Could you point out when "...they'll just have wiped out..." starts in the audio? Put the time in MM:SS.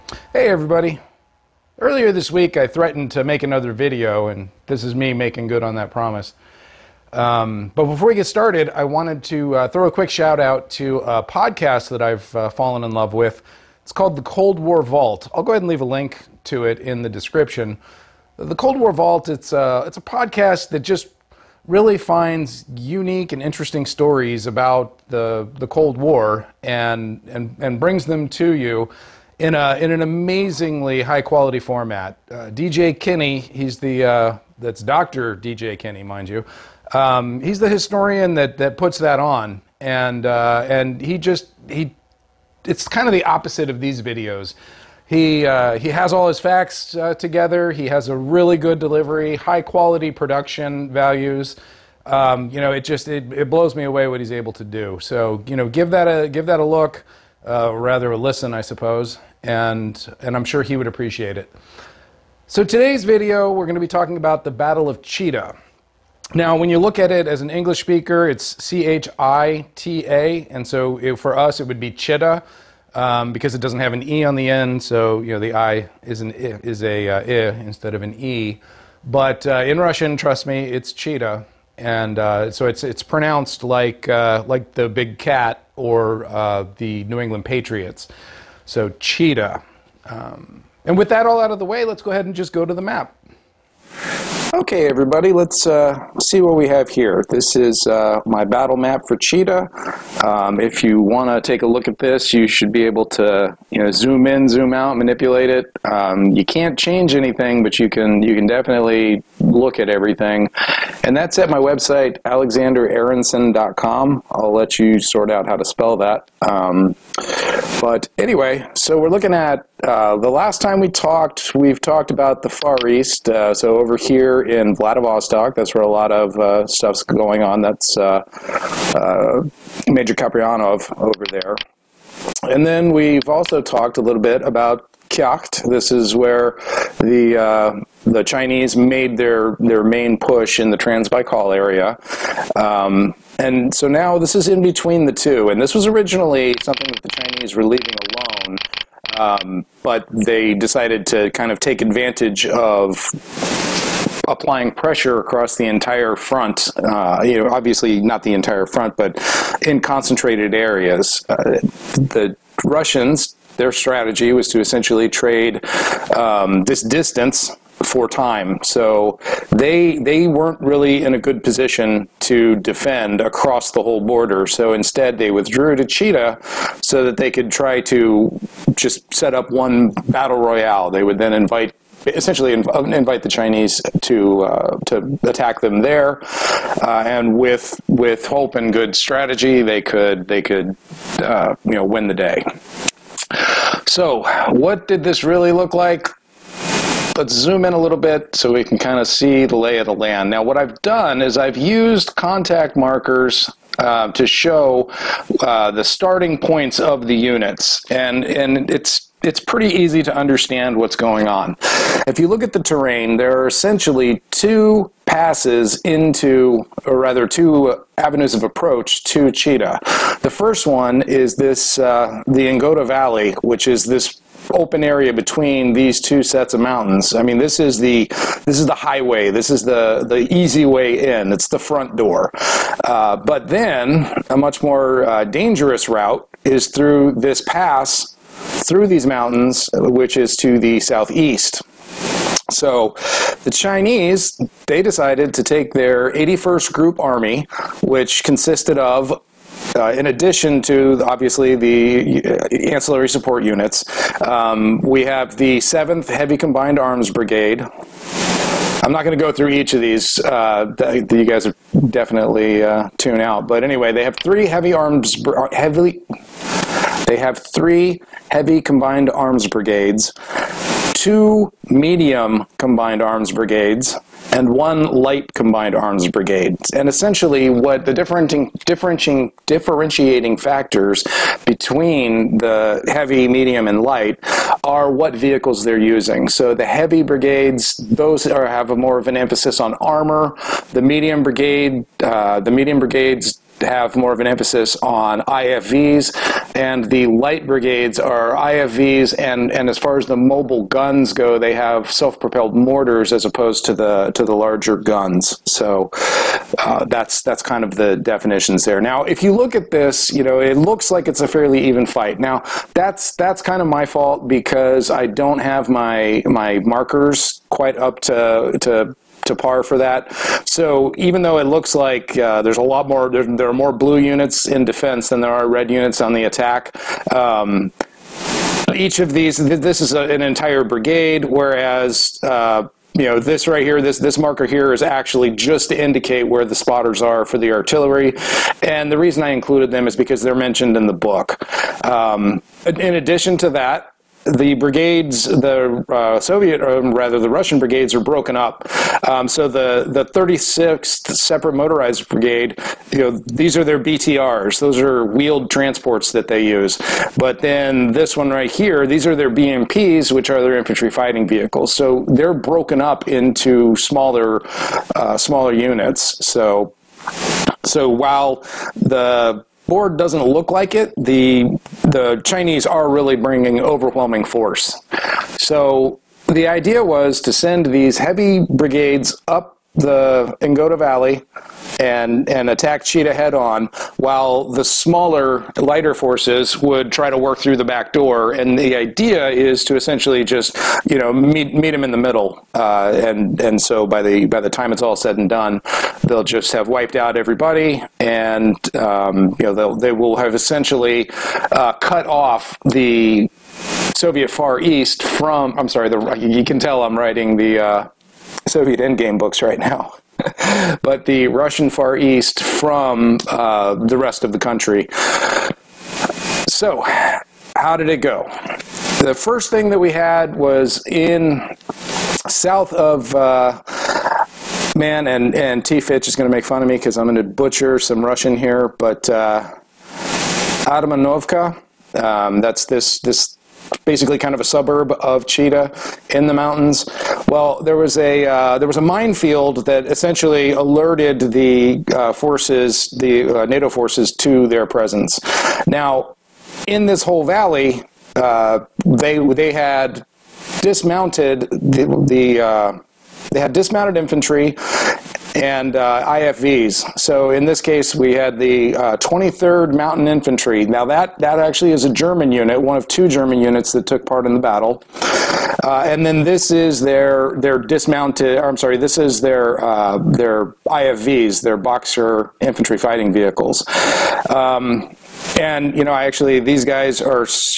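06:36.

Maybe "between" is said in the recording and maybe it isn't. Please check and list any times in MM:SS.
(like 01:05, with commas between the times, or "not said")
02:24, 03:45, 04:41.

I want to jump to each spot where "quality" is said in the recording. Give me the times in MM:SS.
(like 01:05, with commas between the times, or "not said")
00:31, 00:49.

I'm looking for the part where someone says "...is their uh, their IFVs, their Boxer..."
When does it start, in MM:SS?
07:48.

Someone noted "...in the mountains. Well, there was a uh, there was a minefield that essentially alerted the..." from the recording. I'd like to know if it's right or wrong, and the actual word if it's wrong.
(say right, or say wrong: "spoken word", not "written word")
right.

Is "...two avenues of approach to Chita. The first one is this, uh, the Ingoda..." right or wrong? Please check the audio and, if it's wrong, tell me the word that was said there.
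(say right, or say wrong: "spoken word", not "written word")
right.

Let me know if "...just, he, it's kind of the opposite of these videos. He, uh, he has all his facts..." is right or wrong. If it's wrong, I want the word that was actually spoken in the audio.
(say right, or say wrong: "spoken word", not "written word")
right.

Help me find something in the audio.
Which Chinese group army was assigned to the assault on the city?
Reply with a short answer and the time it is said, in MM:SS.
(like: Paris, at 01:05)
81st Group Army, at 04:06.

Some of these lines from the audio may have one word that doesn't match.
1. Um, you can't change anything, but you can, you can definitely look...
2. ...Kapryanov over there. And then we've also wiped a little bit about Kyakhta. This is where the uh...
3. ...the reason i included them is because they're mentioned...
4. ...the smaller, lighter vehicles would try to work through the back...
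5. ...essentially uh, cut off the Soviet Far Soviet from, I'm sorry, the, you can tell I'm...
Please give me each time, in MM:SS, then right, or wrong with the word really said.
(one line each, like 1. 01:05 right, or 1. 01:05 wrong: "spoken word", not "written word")
1. 01:45 right
2. 02:10 wrong: "talked", not "wiped"
3. 05:38 right
4. 06:24 wrong: "forces", not "vehicles"
5. 06:40 wrong: "East", not "Soviet".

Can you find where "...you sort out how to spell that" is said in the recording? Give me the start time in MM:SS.
01:54.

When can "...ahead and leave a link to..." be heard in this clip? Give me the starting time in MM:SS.
00:15.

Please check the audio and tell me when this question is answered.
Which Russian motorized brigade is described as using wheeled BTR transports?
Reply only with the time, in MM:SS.
05:50.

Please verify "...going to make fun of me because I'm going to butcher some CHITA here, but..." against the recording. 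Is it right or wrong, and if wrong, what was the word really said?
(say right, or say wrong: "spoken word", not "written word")
wrong: "Russian", not "CHITA".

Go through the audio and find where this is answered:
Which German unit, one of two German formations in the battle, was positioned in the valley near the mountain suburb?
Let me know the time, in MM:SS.
07:38.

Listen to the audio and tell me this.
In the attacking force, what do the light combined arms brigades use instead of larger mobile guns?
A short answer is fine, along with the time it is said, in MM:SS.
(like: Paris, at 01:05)
self-propelled mortars, at 05:01.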